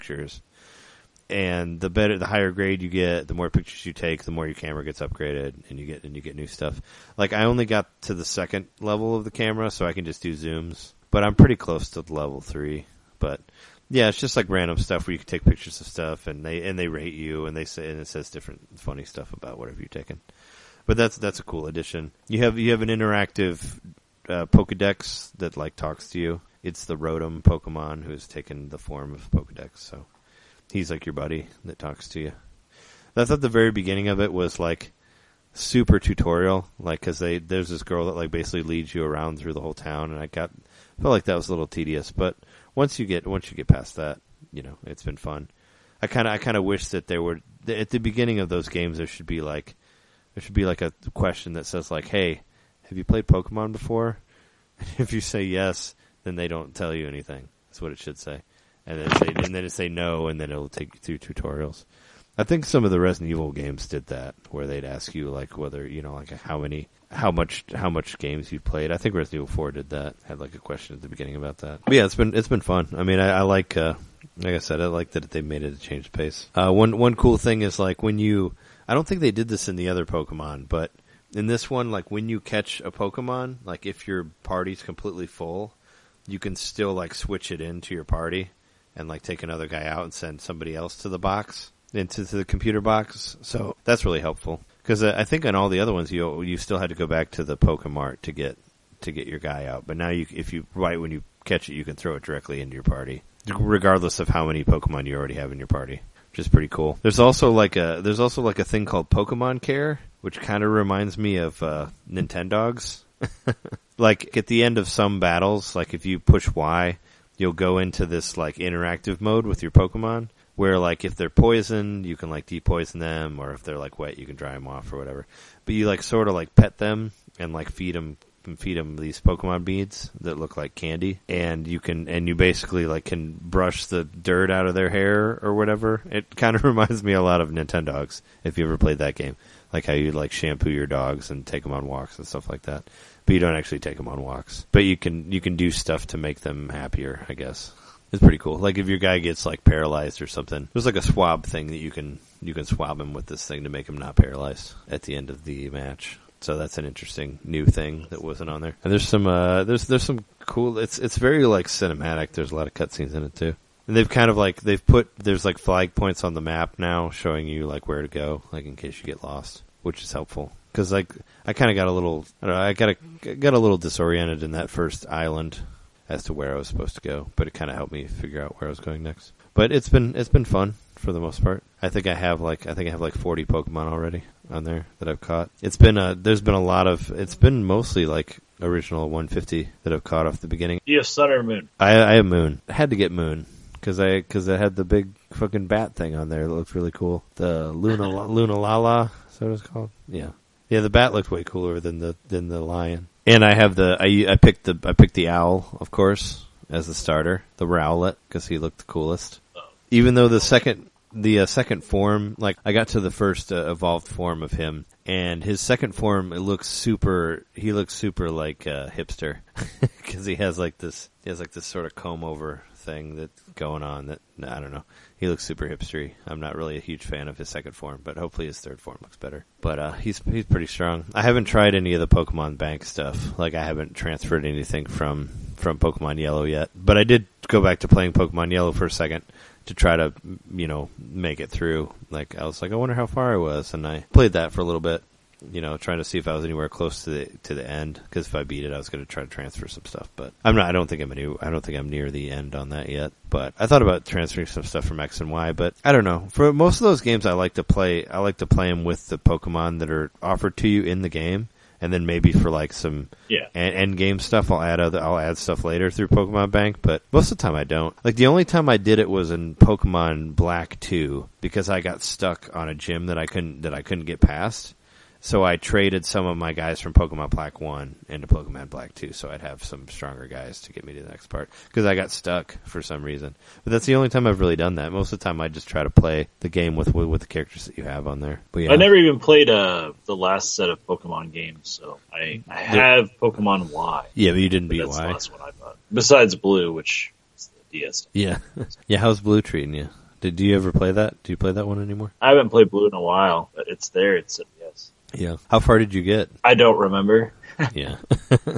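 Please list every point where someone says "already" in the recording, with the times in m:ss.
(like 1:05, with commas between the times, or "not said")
1:45, 3:03.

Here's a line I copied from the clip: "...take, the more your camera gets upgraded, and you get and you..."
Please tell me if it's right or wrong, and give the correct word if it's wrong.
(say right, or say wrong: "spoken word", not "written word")
right.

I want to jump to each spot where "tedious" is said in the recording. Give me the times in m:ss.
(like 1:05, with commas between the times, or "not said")
0:41.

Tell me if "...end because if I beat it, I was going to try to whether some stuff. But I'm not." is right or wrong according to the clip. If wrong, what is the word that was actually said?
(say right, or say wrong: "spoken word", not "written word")
wrong: "transfer", not "whether".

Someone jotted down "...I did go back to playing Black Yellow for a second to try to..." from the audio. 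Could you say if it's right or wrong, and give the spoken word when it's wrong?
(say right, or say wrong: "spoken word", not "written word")
wrong: "Pokemon", not "Black".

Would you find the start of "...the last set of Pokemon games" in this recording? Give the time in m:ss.
4:50.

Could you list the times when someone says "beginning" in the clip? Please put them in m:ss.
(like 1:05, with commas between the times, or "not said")
0:33, 0:47, 1:11, 3:10.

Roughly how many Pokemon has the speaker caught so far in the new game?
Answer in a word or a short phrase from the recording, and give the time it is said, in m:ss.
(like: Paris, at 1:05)
40, at 3:03.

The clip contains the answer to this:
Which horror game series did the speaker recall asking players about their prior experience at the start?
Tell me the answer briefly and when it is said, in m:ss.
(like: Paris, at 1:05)
Resident Evil Four, at 1:09.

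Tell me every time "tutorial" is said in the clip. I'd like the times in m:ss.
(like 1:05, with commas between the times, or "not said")
0:35, 1:01.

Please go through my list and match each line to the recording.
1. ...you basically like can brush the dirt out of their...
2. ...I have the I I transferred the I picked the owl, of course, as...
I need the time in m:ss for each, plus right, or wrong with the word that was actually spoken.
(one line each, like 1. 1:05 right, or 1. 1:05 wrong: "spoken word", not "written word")
1. 2:12 right
2. 3:23 wrong: "picked", not "transferred".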